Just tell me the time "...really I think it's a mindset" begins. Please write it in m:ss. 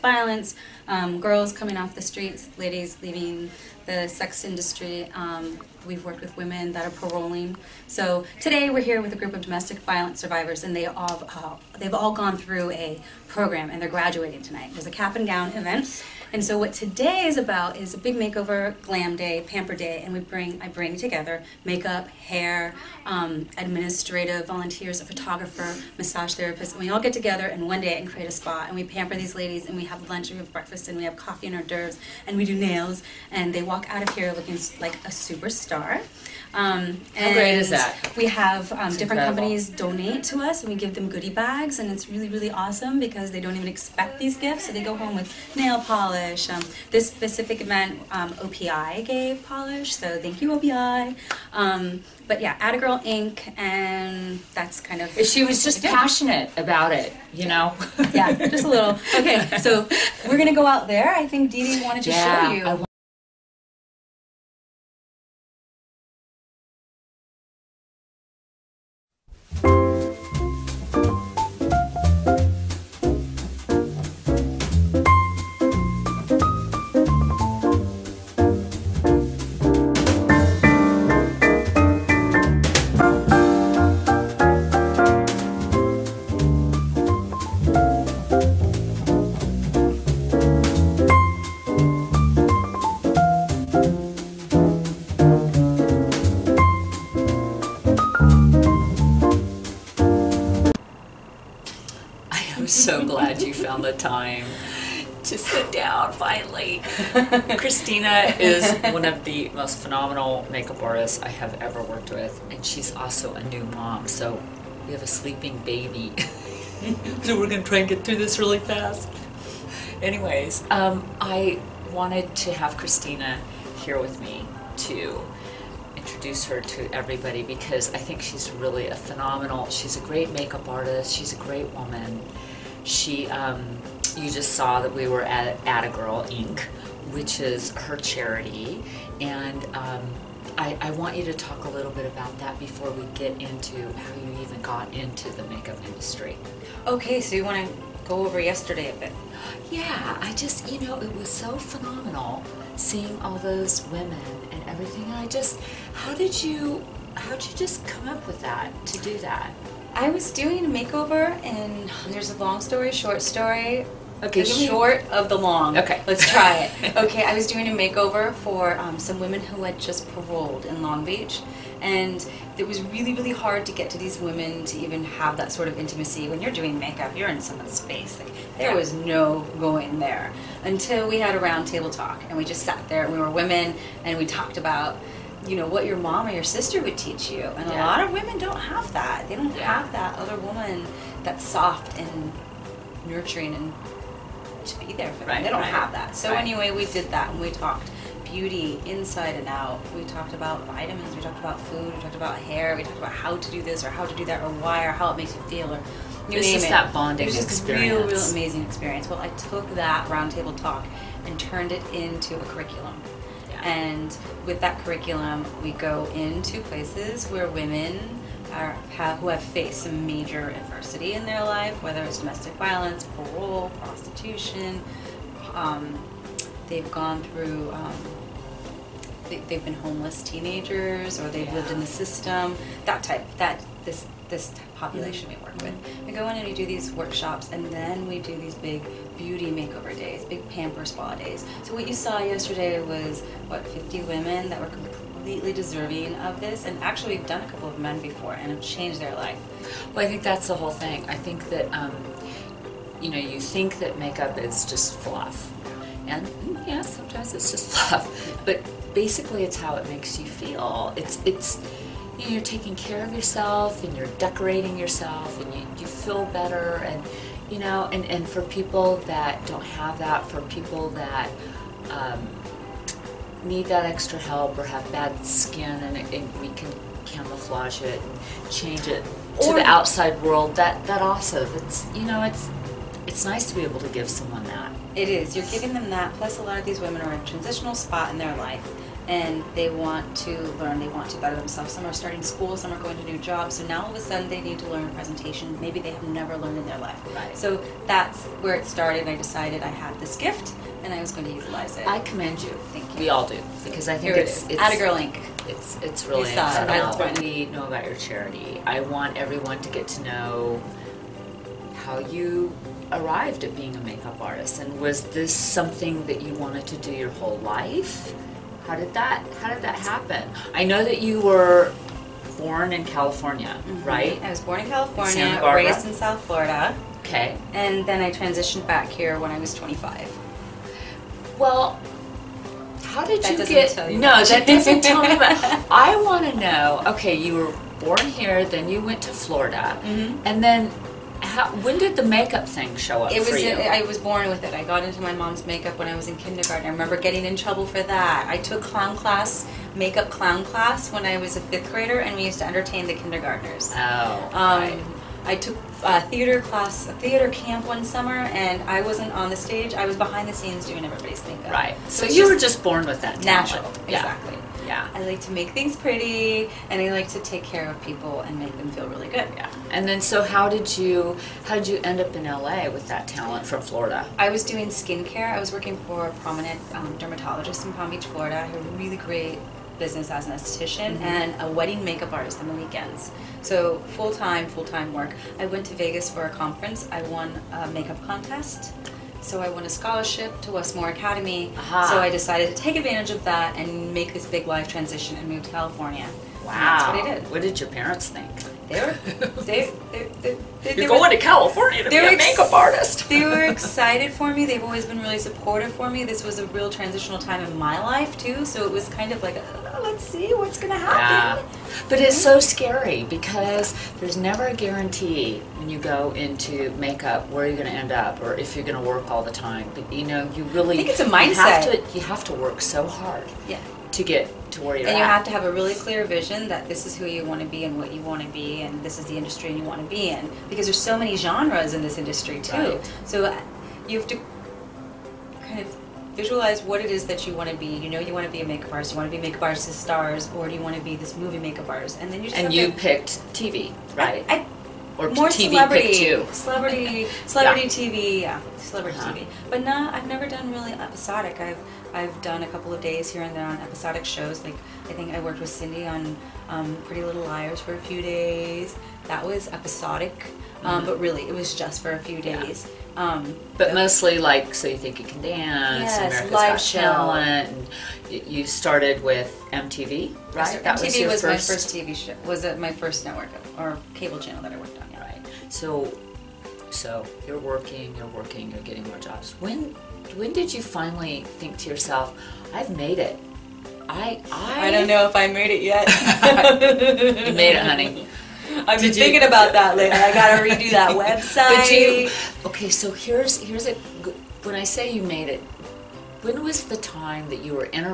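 7:00.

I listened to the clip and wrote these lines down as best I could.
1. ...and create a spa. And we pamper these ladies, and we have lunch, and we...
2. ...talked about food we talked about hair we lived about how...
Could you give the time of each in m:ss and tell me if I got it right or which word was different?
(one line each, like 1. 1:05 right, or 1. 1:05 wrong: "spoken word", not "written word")
1. 0:27 right
2. 3:21 wrong: "talked", not "lived".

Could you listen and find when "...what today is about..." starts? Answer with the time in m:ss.
0:16.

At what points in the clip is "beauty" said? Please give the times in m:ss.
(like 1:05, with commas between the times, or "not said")
3:18, 3:59.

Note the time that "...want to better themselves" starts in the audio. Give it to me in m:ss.
4:50.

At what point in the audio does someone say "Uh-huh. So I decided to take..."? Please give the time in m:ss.
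6:31.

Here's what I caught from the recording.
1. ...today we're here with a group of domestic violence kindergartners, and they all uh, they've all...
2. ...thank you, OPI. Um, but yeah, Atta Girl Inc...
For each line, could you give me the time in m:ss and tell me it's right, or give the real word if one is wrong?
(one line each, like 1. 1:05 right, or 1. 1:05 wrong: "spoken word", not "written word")
1. 0:08 wrong: "survivors", not "kindergartners"
2. 0:50 right.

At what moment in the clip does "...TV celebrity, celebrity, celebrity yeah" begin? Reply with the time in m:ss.
7:25.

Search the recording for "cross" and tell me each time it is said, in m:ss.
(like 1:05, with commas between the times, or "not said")
not said.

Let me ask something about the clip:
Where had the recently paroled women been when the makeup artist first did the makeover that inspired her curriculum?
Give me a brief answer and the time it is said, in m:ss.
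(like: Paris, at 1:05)
Long Beach, at 2:50.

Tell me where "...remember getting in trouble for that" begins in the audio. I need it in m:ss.
5:46.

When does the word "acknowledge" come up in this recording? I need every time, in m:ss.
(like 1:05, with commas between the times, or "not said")
not said.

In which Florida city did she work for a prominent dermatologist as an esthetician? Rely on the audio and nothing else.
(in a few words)
Palm Beach.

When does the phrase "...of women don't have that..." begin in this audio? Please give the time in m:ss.
3:08.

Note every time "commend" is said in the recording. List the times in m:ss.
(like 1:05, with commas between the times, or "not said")
5:02.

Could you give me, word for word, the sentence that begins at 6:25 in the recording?
I went to Vegas for a conference.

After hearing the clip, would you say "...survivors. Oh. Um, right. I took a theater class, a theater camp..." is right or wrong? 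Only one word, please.
wrong.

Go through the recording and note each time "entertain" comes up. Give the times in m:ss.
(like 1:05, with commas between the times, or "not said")
5:52.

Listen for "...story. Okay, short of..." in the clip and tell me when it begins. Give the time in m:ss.
2:43.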